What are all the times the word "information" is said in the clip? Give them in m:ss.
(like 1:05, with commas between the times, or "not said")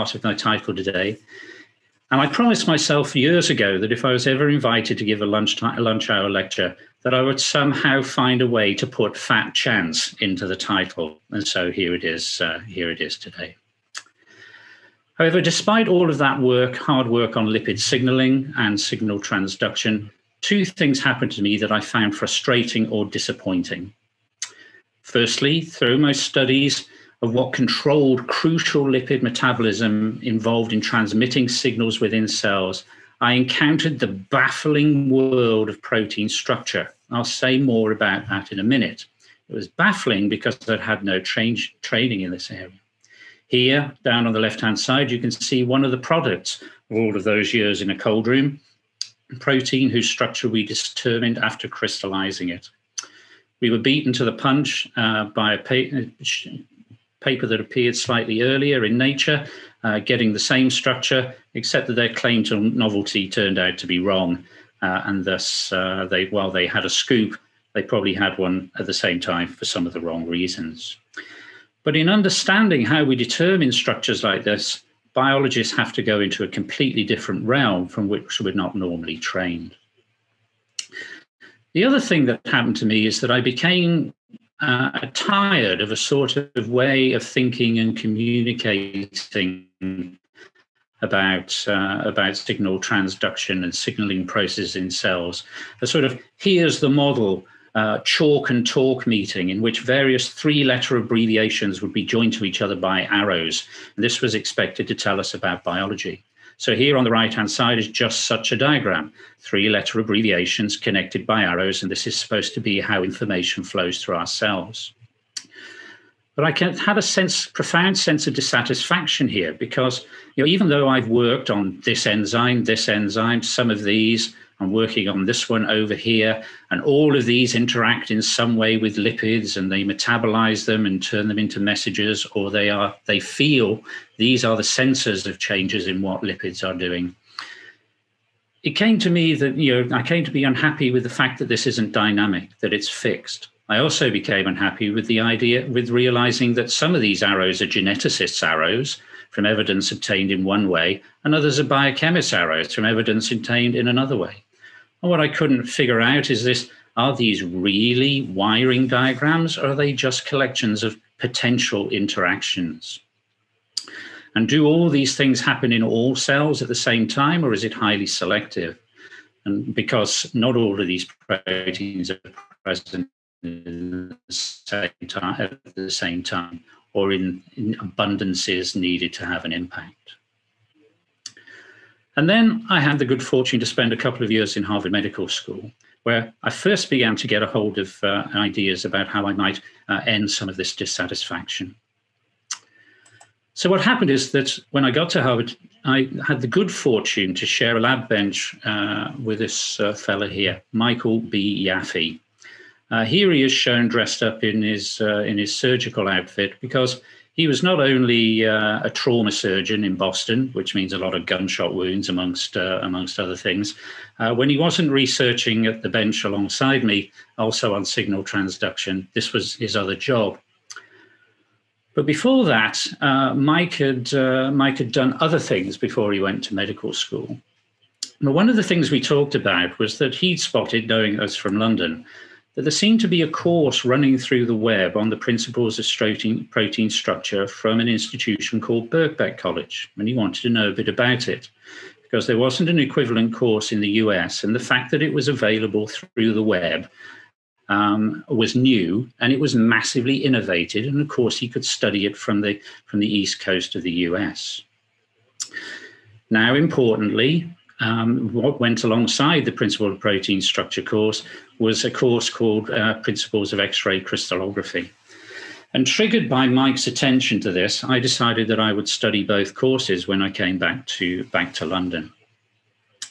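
1:53.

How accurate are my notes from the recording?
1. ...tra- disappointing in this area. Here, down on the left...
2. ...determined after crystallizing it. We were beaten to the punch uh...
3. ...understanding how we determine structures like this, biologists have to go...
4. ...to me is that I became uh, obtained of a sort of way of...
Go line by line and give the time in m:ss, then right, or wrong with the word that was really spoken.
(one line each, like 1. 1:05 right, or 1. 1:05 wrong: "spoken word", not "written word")
1. 0:41 wrong: "training", not "disappointing"
2. 0:50 right
3. 1:12 right
4. 1:22 wrong: "tired", not "obtained".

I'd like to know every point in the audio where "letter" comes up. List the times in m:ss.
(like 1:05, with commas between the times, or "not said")
1:40, 1:49.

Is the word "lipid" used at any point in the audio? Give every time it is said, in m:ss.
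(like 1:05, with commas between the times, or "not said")
0:17, 0:28, 2:08, 2:16.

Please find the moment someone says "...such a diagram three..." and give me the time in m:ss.
1:48.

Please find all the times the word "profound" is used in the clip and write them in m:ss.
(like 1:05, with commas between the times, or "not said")
1:57.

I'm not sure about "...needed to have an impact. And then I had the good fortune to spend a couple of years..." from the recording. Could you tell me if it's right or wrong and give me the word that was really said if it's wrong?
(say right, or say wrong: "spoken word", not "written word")
right.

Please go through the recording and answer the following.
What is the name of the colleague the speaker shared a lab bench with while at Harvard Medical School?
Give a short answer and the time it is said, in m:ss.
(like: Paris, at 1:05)
Michael B. Yaffe, at 3:20.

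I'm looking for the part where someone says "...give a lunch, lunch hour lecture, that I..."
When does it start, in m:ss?
0:05.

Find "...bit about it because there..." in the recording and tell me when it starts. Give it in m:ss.
4:00.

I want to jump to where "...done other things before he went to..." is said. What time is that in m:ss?
3:44.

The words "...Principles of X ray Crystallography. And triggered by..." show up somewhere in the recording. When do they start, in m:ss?
4:23.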